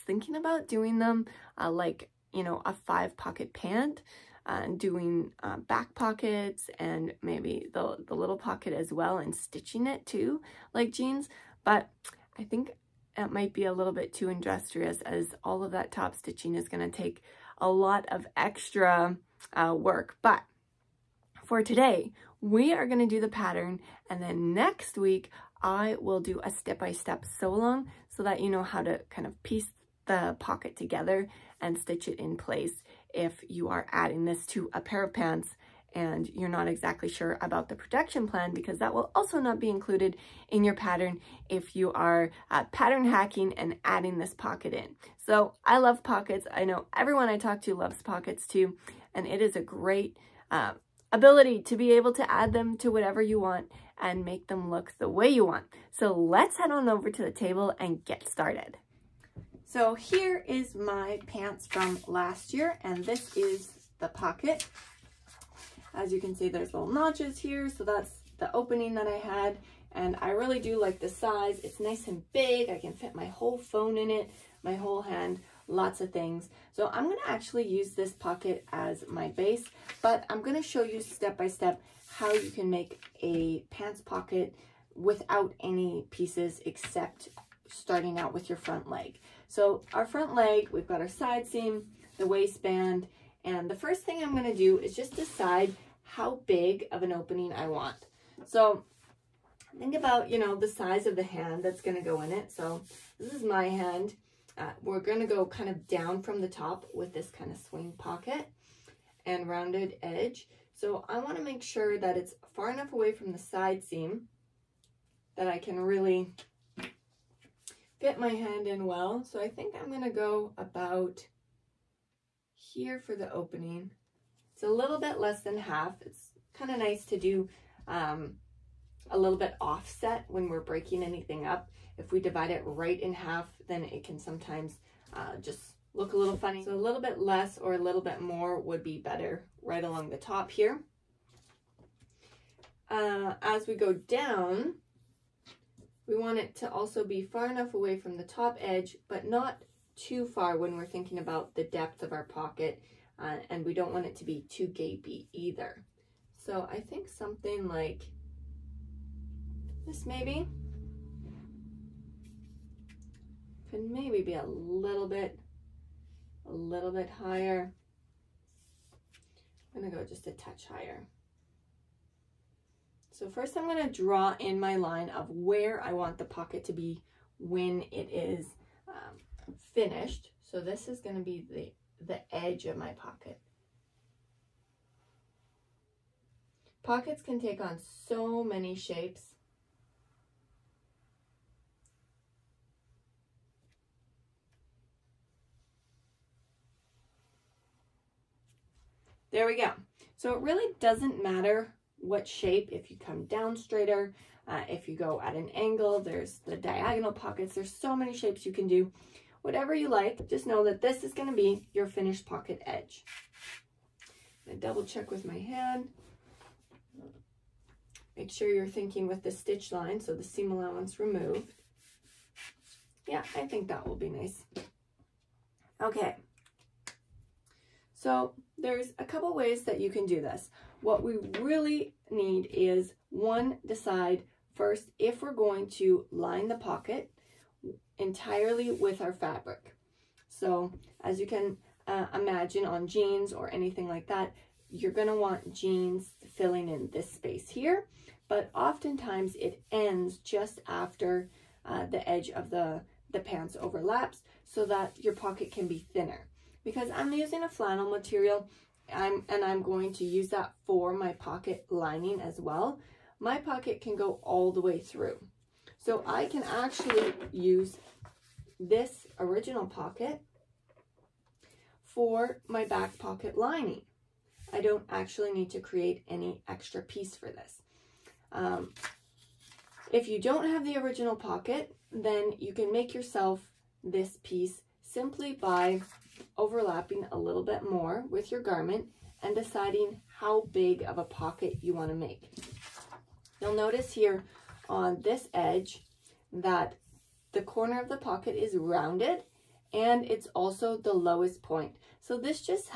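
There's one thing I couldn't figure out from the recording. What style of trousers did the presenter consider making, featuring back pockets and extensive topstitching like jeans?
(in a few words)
five pocket pant.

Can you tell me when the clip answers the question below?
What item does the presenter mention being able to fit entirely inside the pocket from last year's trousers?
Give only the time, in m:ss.
1:13.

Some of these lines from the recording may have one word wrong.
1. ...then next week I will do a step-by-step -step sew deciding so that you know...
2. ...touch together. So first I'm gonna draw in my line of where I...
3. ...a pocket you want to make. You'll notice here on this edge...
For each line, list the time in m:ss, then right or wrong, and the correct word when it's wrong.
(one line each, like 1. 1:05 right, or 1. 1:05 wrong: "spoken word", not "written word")
1. 0:24 wrong: "along", not "deciding"
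2. 2:50 wrong: "higher", not "together"
3. 4:50 right.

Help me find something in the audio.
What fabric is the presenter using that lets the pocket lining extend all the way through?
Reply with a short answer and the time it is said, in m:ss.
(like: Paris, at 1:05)
flannel, at 4:17.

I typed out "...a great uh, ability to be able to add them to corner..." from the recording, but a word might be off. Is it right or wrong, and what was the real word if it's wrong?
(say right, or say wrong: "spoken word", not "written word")
wrong: "whatever", not "corner".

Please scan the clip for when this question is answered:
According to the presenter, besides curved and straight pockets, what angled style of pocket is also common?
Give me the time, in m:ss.
3:26.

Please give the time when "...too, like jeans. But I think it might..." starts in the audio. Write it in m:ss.
0:10.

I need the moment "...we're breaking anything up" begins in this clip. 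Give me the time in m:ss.
2:10.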